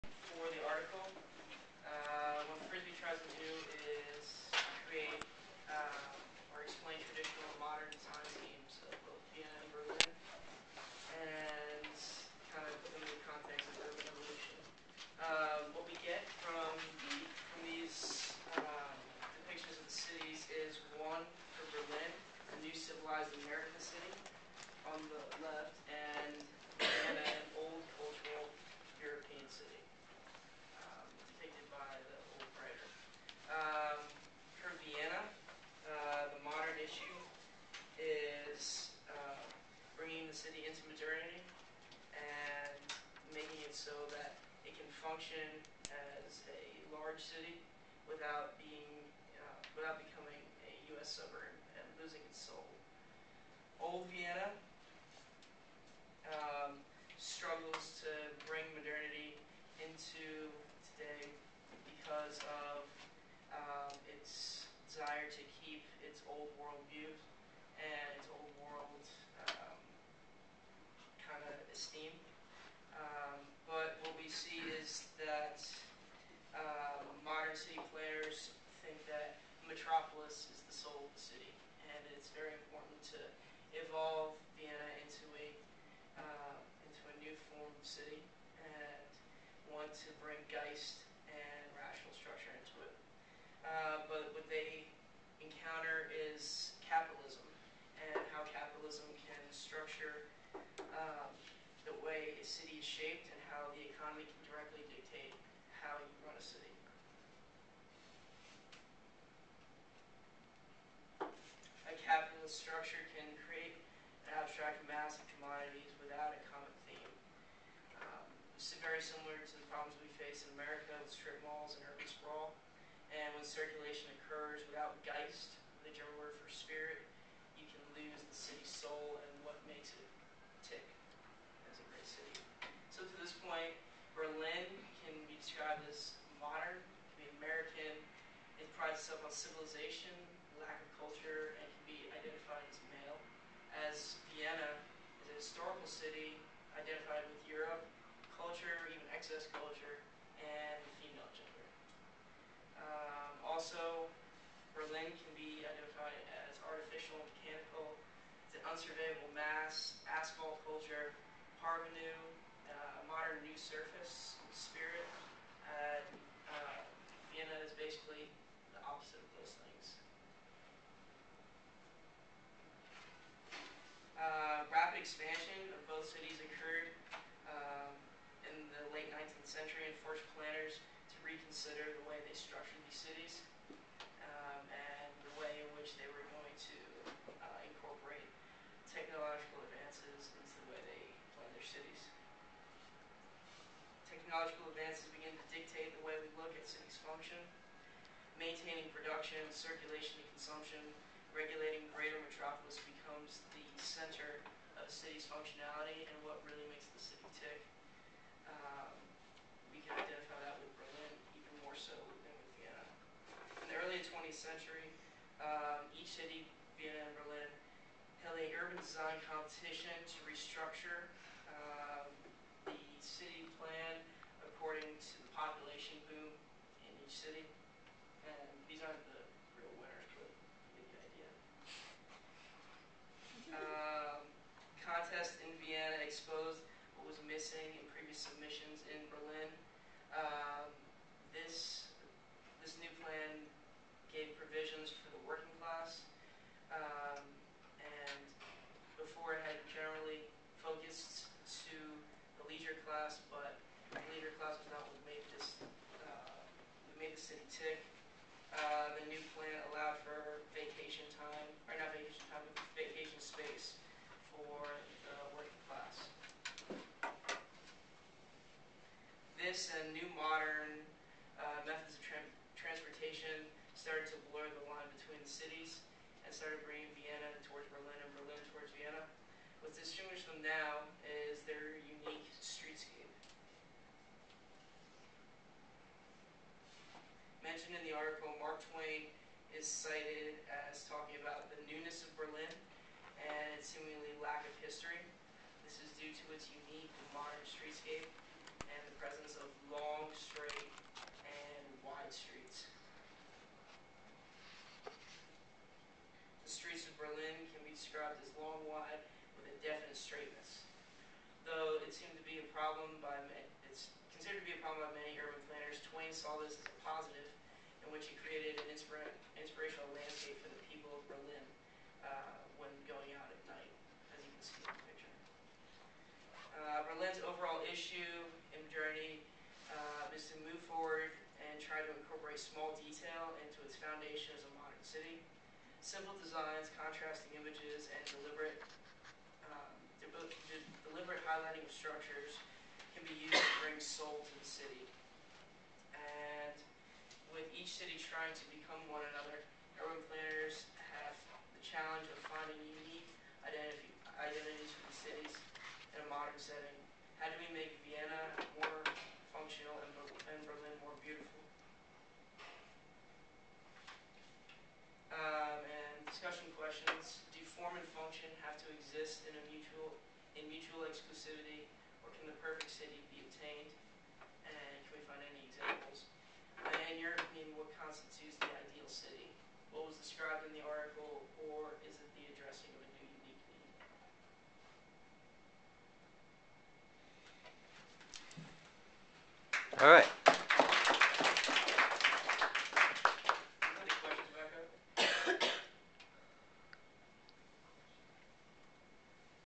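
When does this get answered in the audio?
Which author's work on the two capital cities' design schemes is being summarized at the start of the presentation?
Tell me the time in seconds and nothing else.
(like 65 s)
2 s.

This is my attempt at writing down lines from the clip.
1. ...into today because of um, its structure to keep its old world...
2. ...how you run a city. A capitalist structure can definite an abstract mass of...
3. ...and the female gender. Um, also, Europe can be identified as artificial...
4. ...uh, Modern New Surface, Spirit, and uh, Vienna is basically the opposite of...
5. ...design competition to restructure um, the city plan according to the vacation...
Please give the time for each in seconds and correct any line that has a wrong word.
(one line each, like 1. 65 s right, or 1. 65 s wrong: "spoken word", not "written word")
1. 59 s wrong: "desire", not "structure"
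2. 105 s wrong: "create", not "definite"
3. 150 s wrong: "Berlin", not "Europe"
4. 162 s right
5. 218 s wrong: "population", not "vacation".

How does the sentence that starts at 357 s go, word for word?
How do we make Vienna more functional and Berlin more beautiful?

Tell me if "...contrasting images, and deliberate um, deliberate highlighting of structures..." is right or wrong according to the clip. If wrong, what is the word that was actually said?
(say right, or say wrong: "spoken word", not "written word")
right.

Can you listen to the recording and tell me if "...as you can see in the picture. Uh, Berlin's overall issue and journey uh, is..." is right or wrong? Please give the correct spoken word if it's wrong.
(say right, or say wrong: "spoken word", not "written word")
right.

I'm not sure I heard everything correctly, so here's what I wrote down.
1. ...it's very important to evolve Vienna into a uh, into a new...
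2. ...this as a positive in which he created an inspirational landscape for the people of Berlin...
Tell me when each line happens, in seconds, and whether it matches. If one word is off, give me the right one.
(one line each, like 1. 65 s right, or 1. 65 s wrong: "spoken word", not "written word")
1. 82 s right
2. 316 s right.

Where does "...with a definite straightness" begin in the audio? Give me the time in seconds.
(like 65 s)
309 s.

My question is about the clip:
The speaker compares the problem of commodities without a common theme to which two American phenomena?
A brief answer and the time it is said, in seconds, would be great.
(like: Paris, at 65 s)
Strip malls and urban sprawl, at 121 s.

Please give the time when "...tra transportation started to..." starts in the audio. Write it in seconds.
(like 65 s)
272 s.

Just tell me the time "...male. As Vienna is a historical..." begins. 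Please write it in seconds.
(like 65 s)
142 s.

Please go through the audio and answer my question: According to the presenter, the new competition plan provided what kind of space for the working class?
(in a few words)
Vacation space.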